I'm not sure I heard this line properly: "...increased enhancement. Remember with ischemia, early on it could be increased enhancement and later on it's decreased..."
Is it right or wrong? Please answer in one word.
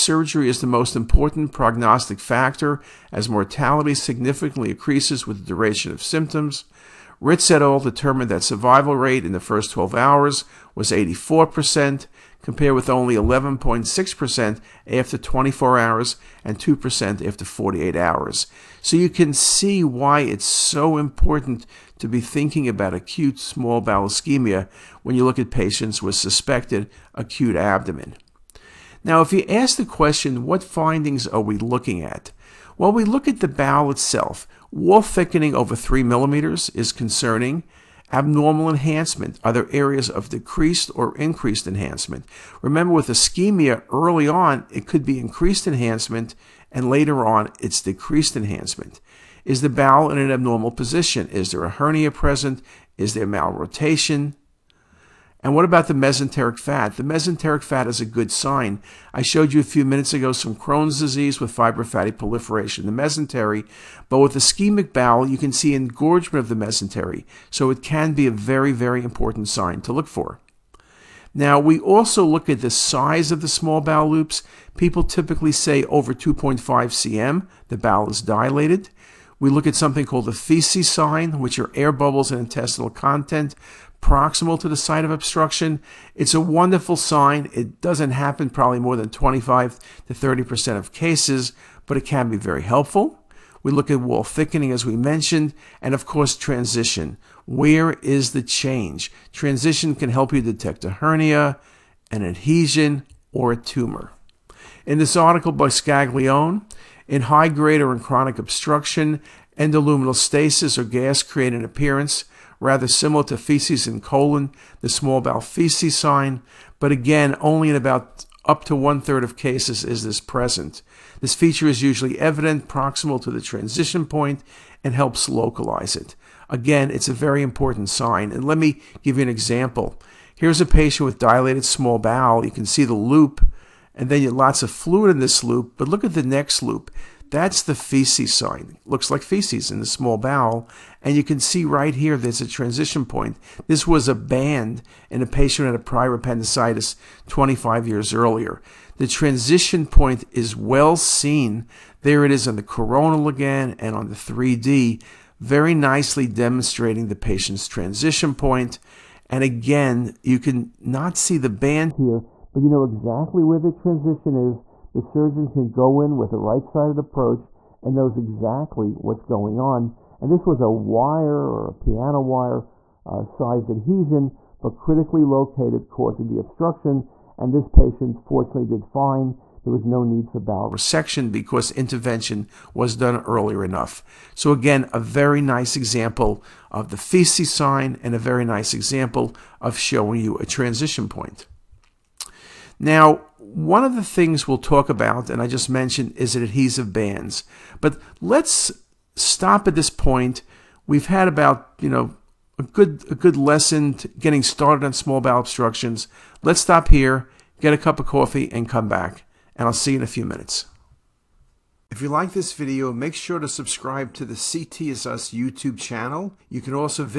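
right.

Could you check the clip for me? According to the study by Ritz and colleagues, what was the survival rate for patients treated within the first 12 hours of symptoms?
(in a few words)
84%.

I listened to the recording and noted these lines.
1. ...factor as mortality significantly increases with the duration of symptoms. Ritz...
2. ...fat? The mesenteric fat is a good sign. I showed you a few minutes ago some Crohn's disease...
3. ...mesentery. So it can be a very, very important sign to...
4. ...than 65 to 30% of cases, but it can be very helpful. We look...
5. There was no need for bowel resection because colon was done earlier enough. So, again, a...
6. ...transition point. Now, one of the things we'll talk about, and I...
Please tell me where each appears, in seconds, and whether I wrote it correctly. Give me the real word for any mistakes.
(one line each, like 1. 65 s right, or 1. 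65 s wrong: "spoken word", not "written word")
1. 2 s right
2. 56 s right
3. 66 s right
4. 88 s wrong: "25", not "65"
5. 179 s wrong: "intervention", not "colon"
6. 190 s right.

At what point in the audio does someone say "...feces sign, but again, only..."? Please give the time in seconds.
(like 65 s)
115 s.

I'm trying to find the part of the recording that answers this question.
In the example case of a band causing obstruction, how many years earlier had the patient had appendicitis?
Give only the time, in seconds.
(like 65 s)
147 s.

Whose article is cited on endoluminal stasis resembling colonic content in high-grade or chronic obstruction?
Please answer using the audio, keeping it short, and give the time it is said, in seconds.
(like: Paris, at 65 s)
Scaglione, at 105 s.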